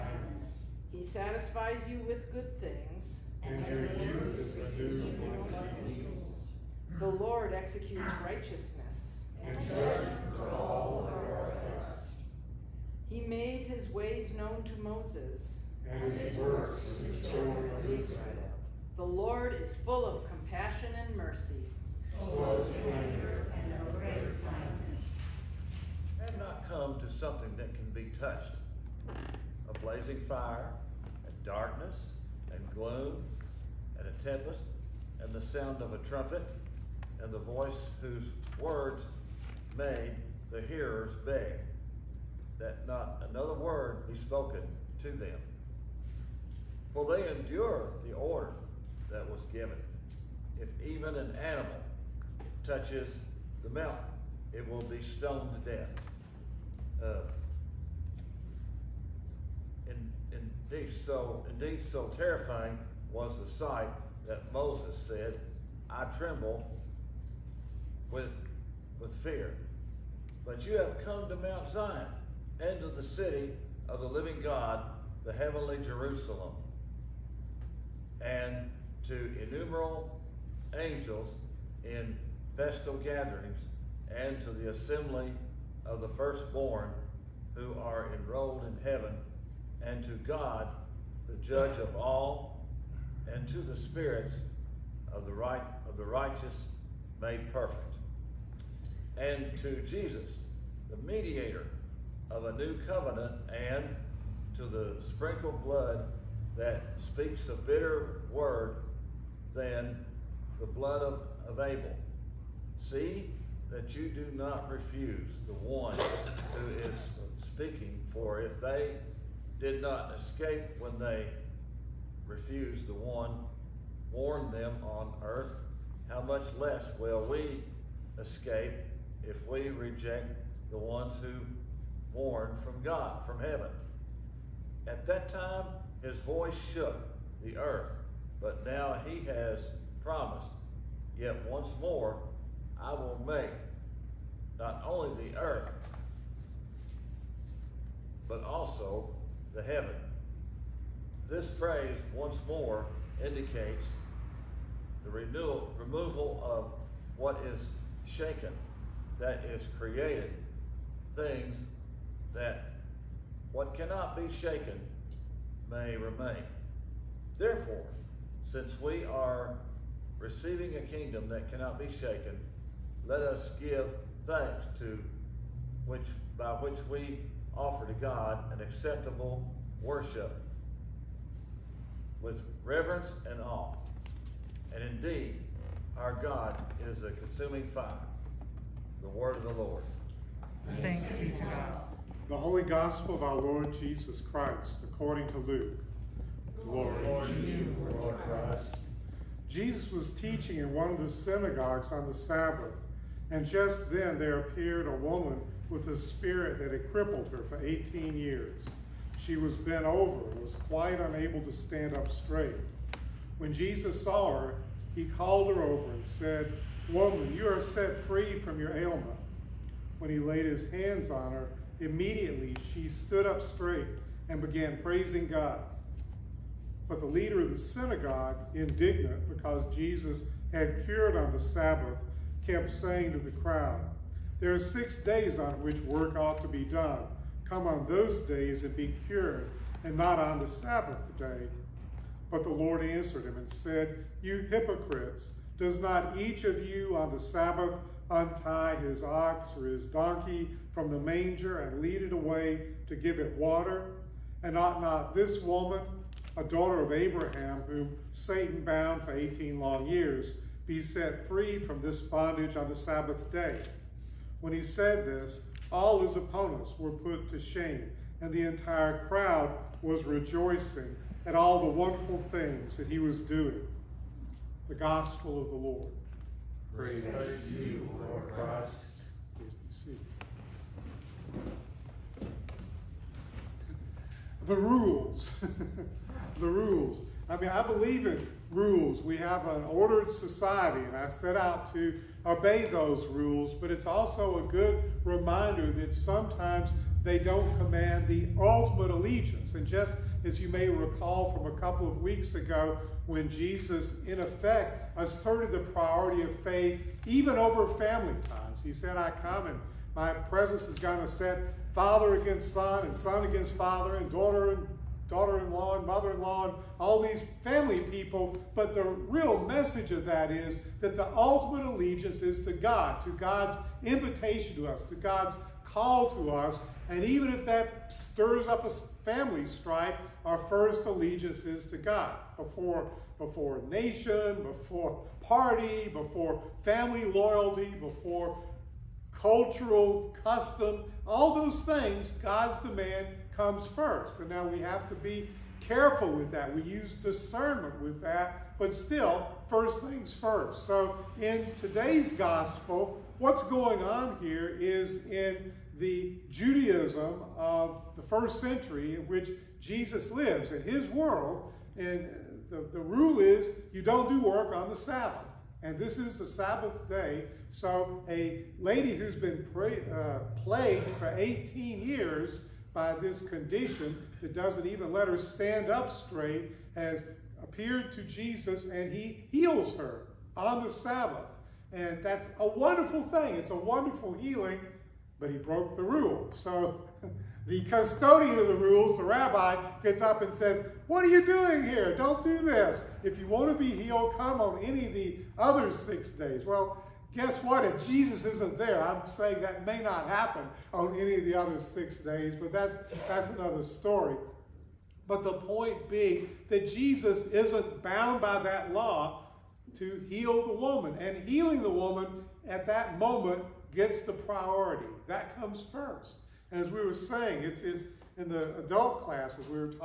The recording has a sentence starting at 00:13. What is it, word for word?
He made his ways known to Moses and his works to the children of Israel.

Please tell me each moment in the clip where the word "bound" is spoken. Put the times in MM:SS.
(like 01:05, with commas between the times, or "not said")
04:18, 06:47.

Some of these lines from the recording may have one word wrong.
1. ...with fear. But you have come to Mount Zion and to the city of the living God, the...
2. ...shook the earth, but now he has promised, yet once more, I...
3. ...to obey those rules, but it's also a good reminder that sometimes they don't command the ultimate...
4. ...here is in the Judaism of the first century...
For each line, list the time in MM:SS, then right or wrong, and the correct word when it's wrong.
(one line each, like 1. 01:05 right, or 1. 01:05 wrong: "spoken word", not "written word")
1. 01:09 right
2. 02:16 right
3. 04:51 right
4. 05:54 right.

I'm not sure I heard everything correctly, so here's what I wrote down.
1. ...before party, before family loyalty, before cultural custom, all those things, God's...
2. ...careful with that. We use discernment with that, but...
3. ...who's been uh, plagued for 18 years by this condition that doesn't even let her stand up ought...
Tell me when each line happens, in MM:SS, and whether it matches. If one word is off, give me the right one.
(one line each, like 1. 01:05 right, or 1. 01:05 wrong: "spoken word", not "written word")
1. 05:34 right
2. 05:45 right
3. 06:08 wrong: "straight", not "ought".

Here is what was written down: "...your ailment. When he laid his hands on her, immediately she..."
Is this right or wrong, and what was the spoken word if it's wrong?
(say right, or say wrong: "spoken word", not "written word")
right.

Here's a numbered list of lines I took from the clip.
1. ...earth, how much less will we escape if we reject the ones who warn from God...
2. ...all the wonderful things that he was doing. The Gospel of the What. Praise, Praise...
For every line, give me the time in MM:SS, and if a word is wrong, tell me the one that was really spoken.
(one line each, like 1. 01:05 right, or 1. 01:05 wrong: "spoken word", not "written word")
1. 02:05 right
2. 04:31 wrong: "Lord", not "What".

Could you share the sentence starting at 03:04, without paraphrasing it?
And indeed, our God is a consuming fire.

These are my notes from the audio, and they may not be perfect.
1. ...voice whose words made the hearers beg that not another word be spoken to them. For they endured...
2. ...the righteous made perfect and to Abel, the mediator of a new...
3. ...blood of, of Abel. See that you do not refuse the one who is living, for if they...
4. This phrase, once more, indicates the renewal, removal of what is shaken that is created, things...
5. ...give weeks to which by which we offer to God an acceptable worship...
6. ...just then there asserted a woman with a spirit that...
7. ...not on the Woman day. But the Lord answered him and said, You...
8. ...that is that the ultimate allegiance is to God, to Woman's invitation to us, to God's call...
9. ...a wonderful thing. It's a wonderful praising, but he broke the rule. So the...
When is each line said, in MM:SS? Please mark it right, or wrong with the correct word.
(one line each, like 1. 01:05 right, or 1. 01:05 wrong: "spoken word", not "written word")
1. 00:37 right
2. 01:35 wrong: "Jesus", not "Abel"
3. 01:50 wrong: "speaking", not "living"
4. 02:31 right
5. 02:53 wrong: "thanks", not "weeks"
6. 03:23 wrong: "appeared", not "asserted"
7. 03:59 wrong: "Sabbath", not "Woman"
8. 05:20 wrong: "God", not "Woman"
9. 06:22 wrong: "healing", not "praising".